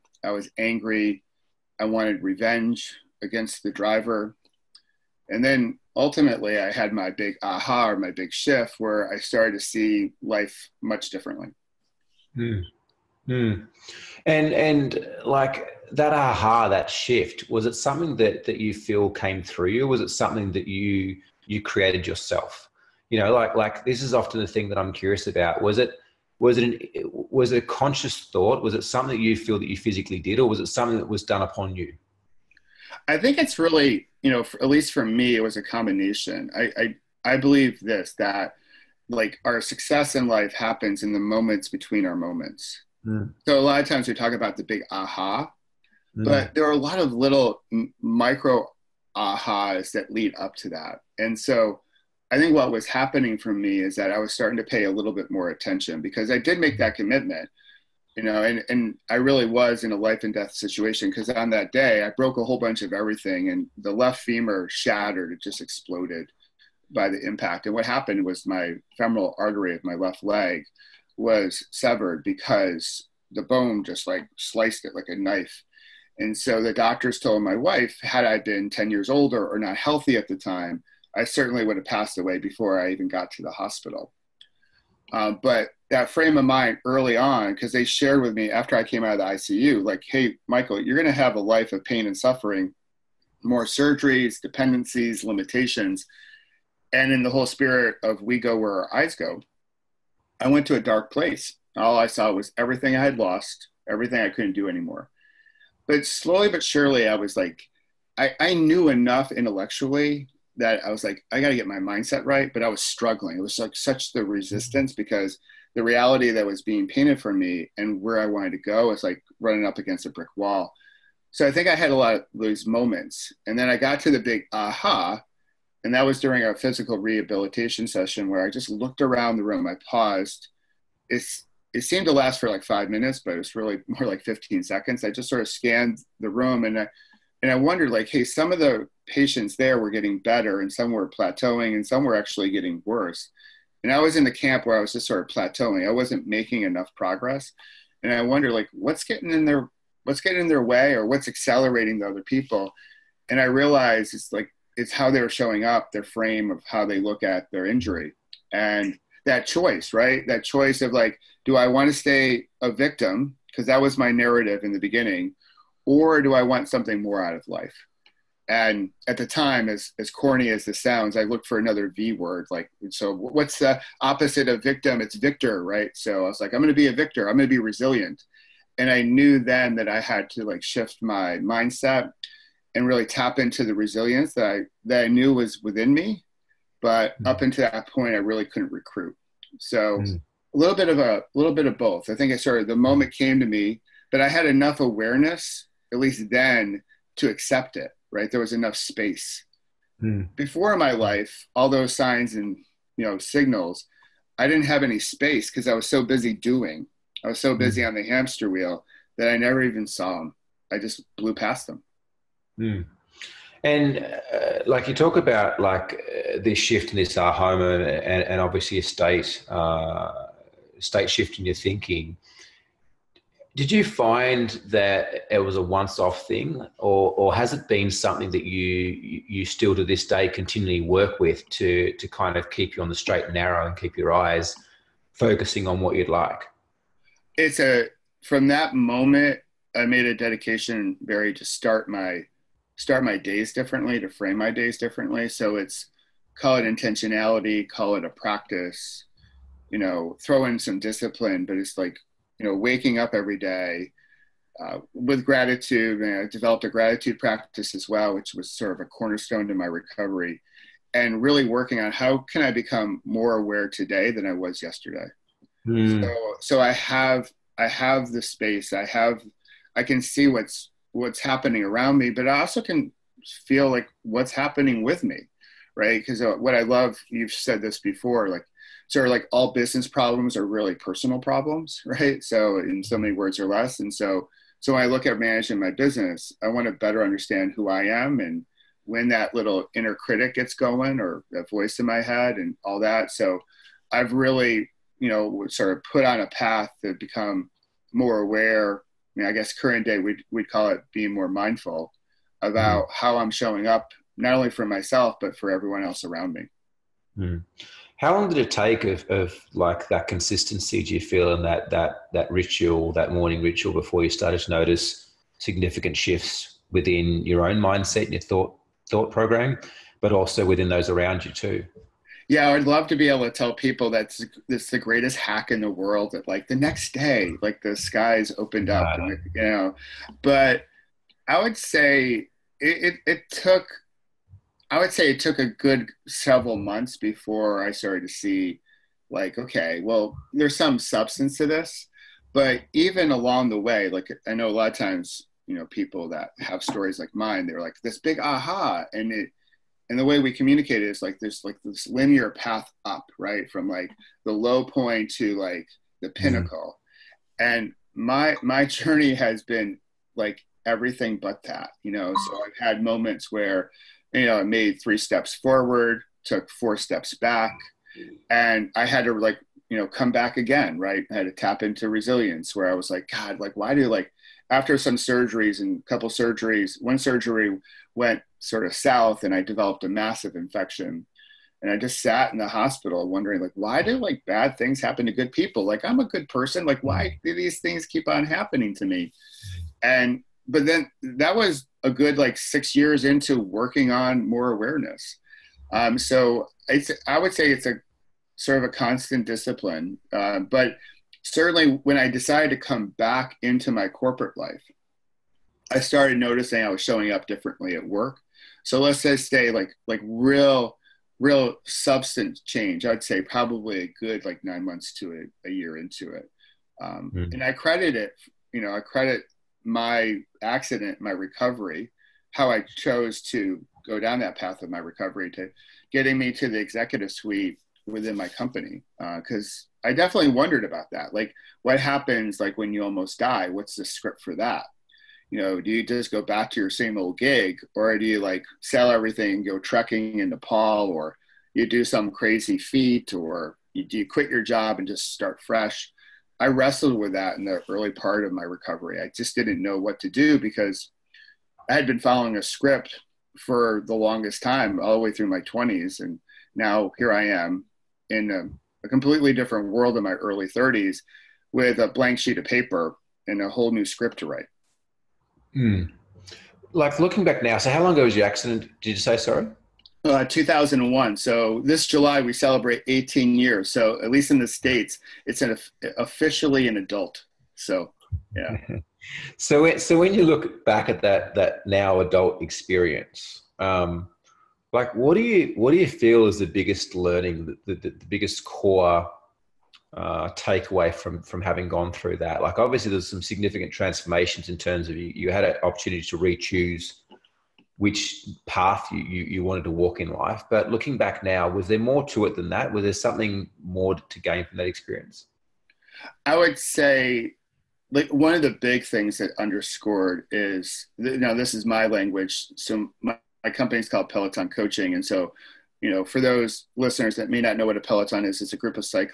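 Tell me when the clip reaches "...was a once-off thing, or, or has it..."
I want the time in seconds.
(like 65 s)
225 s.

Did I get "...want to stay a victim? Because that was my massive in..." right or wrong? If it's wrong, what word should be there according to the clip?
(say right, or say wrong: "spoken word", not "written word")
wrong: "narrative", not "massive".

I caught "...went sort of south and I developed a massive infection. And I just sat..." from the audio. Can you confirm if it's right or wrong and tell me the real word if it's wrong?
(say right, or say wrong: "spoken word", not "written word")
right.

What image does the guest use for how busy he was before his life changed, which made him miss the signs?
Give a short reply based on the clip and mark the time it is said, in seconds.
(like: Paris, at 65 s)
Hamster wheel, at 208 s.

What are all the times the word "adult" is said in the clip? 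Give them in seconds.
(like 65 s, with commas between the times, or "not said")
476 s, 481 s.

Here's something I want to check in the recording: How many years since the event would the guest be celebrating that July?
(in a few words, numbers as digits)
18.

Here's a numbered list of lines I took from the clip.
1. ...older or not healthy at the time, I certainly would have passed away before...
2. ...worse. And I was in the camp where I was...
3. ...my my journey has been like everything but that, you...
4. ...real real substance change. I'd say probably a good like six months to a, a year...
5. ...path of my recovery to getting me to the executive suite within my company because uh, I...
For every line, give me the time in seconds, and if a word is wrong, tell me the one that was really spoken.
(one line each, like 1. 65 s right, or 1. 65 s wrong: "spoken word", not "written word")
1. 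79 s right
2. 142 s right
3. 357 s right
4. 410 s wrong: "nine", not "six"
5. 424 s right.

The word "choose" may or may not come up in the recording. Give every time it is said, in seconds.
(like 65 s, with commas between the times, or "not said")
496 s.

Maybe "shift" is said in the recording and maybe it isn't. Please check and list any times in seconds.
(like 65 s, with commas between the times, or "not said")
8 s, 16 s, 180 s, 216 s, 221 s, 315 s.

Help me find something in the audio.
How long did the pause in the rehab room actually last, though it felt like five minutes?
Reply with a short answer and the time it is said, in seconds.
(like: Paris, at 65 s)
15 seconds, at 134 s.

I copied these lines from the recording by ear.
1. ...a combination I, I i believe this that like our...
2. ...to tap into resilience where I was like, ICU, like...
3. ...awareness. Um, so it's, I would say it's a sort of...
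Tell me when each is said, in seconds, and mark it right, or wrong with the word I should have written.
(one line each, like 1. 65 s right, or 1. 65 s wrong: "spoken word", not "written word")
1. 35 s right
2. 371 s wrong: "God", not "ICU"
3. 394 s right.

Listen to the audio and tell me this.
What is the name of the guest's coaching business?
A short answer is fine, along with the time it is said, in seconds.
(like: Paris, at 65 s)
Peloton Coaching, at 514 s.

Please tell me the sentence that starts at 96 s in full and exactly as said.
And in the whole spirit of we go where our eyes go, I went to a dark place.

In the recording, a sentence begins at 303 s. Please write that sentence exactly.
how I'm showing up, not only for myself, but for everyone else around me.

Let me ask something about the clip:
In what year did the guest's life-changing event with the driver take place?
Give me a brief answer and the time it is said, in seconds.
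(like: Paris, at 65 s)
2001, at 470 s.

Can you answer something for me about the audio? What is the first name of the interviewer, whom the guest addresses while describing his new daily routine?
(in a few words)
Barry.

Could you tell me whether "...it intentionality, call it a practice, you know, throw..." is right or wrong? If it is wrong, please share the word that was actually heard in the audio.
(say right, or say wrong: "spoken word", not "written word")
right.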